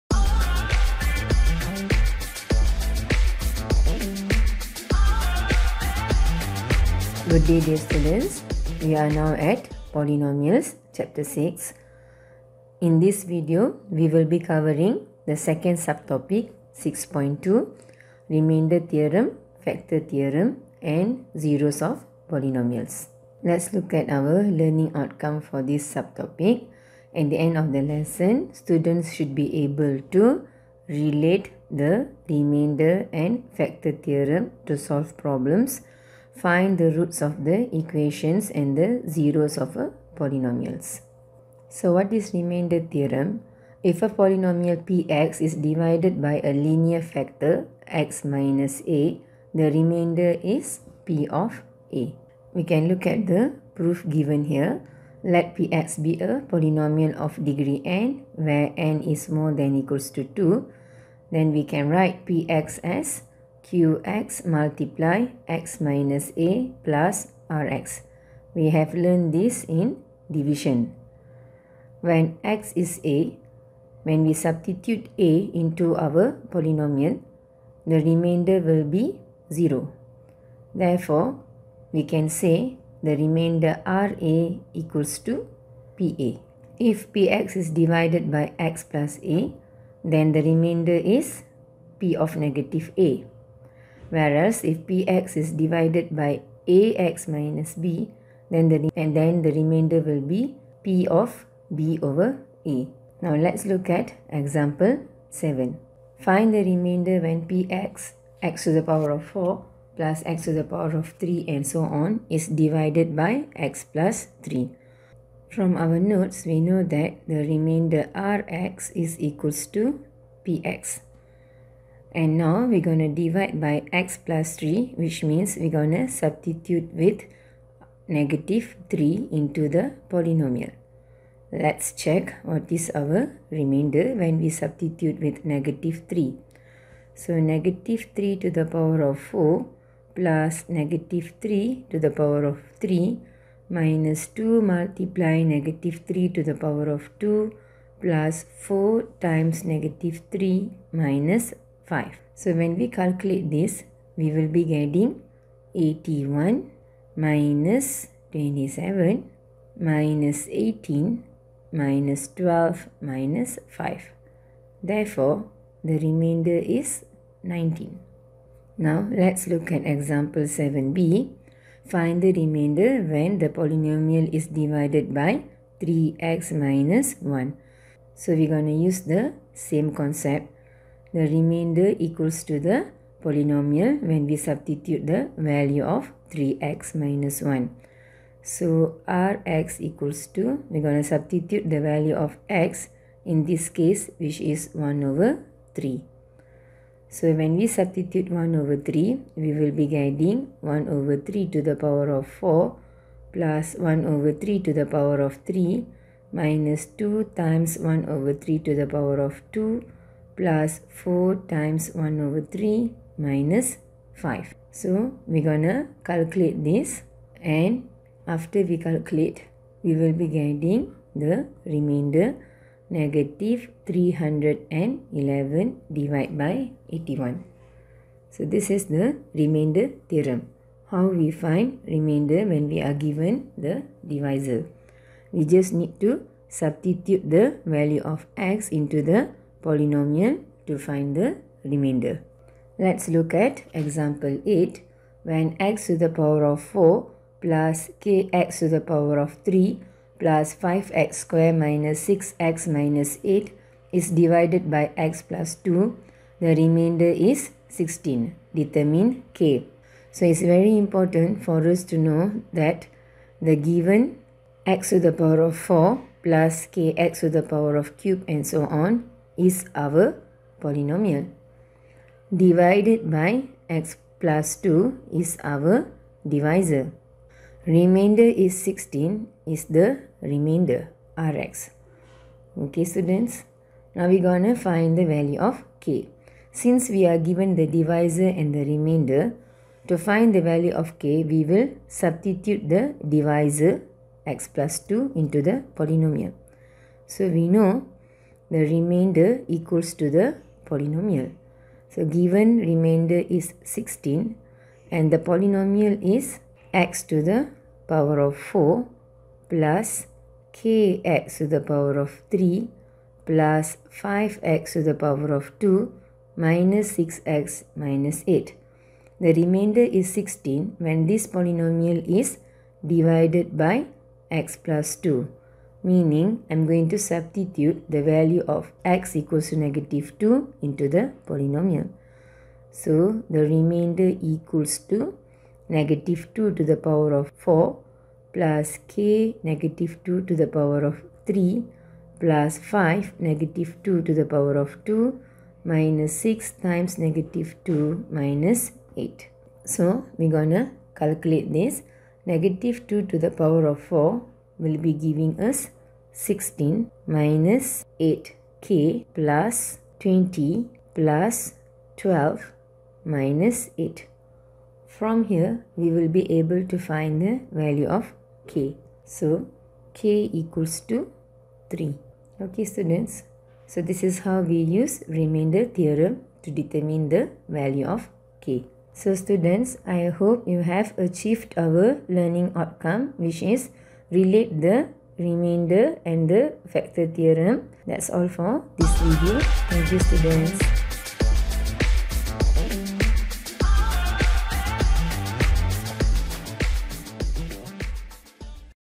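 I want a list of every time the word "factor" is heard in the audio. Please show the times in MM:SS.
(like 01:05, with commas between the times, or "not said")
00:19, 00:33, 00:47, 06:26.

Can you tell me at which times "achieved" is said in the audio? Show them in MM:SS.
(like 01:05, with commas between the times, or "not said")
06:20.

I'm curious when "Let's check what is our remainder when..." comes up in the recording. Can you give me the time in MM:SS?
02:11.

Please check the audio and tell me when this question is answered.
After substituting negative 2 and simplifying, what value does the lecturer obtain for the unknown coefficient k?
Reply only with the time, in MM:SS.
06:09.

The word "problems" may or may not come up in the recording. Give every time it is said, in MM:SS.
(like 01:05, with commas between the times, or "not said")
00:35.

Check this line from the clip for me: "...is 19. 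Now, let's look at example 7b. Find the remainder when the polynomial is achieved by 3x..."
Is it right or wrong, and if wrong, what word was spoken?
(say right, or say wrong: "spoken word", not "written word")
wrong: "divided", not "achieved".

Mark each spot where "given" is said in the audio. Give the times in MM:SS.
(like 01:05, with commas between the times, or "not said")
00:54, 03:52, 04:23, 04:47, 05:02.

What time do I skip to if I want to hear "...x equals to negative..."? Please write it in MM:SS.
05:28.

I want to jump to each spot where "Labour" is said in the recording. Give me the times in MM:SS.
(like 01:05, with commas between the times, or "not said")
not said.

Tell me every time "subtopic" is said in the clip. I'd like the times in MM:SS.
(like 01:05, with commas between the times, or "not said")
00:15, 00:25.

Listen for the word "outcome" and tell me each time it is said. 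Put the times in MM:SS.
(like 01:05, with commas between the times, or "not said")
00:24, 06:22.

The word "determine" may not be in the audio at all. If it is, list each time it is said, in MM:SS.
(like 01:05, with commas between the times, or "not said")
04:18, 06:16.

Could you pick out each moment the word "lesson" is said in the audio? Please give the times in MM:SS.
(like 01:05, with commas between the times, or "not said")
00:27.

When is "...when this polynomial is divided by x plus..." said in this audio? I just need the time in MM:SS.
05:20.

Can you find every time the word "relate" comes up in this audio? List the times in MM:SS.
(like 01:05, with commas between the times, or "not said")
00:30, 06:24.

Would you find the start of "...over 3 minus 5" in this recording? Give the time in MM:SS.
03:32.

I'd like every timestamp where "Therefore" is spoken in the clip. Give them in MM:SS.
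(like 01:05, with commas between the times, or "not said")
01:20, 02:44.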